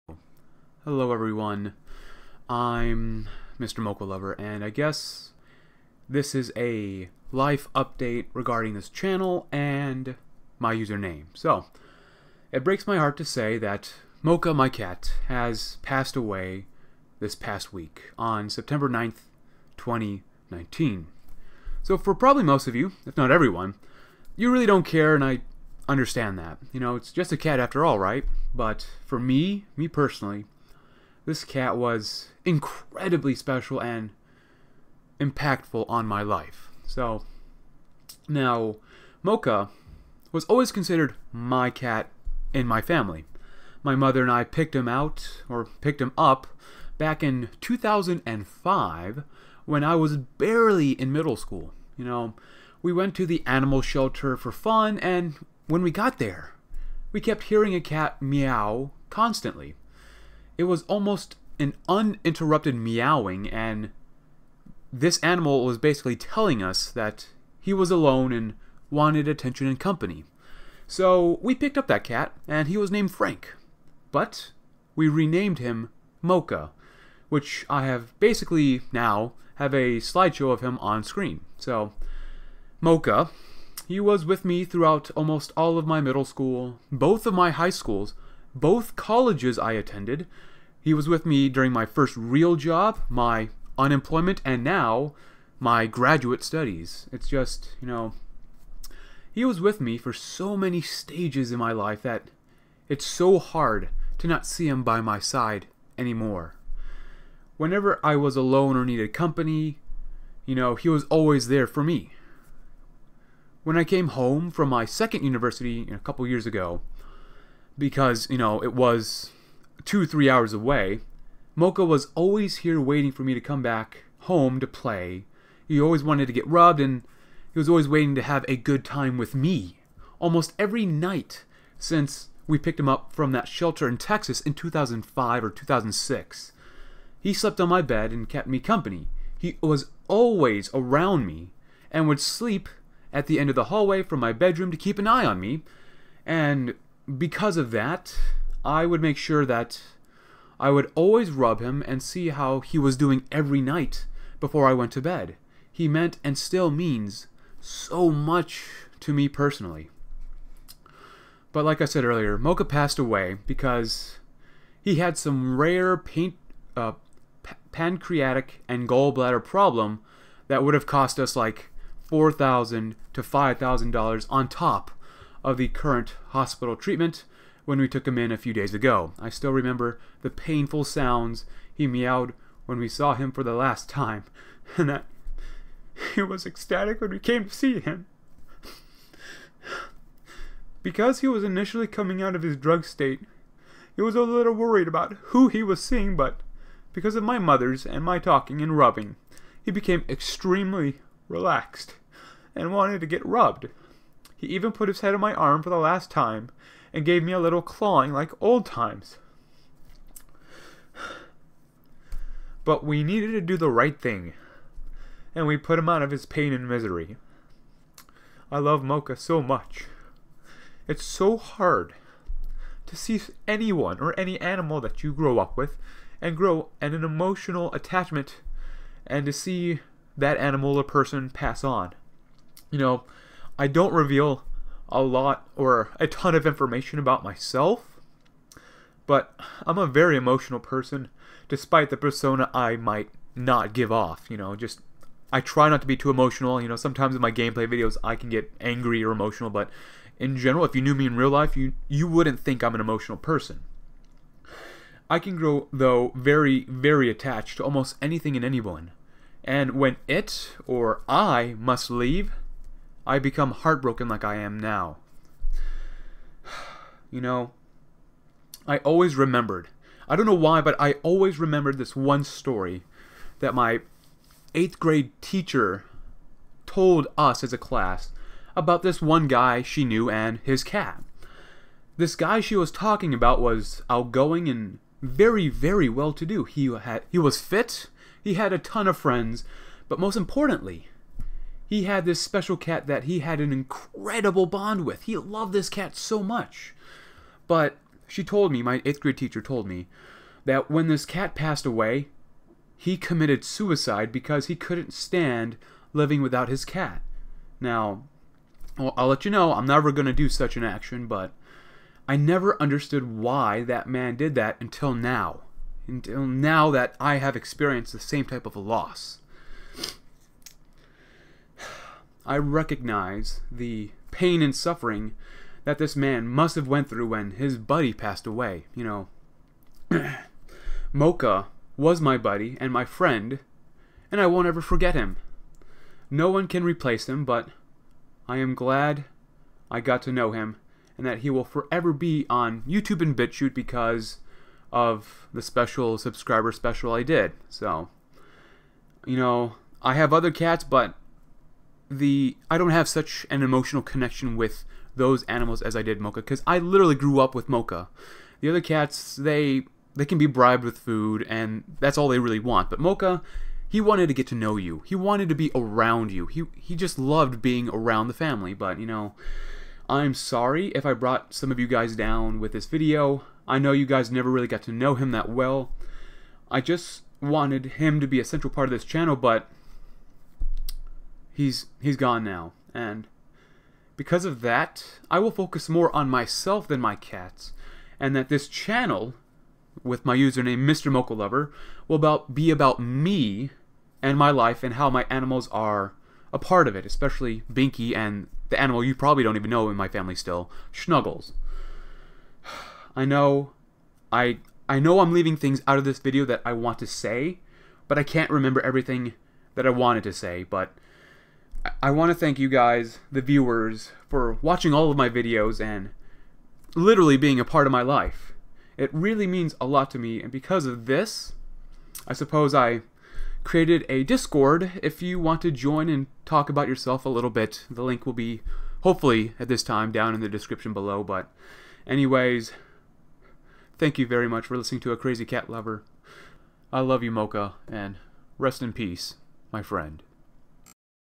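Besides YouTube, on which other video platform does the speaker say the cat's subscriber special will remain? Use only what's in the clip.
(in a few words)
BitChute.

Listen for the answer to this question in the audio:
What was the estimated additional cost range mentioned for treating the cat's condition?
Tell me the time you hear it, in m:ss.
2:52.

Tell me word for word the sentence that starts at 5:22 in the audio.
I recognize the pain and suffering that this man must have went through when his buddy passed away.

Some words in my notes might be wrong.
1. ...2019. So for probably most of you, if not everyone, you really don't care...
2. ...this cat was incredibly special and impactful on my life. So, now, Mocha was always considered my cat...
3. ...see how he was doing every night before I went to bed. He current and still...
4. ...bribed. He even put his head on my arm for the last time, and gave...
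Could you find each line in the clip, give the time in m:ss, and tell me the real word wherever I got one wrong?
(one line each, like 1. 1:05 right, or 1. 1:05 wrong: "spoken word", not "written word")
1. 0:19 right
2. 0:31 right
3. 2:32 wrong: "meant", not "current"
4. 3:23 wrong: "rubbed", not "bribed".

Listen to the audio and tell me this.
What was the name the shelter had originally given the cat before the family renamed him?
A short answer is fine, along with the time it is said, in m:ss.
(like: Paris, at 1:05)
Frank, at 1:13.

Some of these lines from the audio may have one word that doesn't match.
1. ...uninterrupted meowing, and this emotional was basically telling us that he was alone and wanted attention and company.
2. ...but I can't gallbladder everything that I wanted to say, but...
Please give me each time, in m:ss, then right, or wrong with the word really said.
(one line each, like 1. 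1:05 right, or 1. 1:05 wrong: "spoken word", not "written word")
1. 1:01 wrong: "animal", not "emotional"
2. 6:47 wrong: "remember", not "gallbladder".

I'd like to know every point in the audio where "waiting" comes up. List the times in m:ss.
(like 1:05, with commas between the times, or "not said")
2:02, 2:07.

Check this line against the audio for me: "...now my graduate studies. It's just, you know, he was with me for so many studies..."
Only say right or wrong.
wrong.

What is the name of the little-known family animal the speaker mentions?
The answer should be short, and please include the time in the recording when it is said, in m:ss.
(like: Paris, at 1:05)
Snuggles, at 6:40.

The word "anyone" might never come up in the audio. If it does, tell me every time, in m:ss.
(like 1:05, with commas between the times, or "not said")
3:43, 4:18.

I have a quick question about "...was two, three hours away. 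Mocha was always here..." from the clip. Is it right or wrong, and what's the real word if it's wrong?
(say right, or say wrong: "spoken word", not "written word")
right.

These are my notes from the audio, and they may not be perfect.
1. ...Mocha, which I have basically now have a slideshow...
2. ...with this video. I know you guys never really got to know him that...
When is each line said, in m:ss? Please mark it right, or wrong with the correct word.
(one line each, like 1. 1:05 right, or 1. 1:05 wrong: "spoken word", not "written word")
1. 1:16 right
2. 6:12 right.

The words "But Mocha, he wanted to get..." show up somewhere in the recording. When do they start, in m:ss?
6:02.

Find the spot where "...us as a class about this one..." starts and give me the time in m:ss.
4:37.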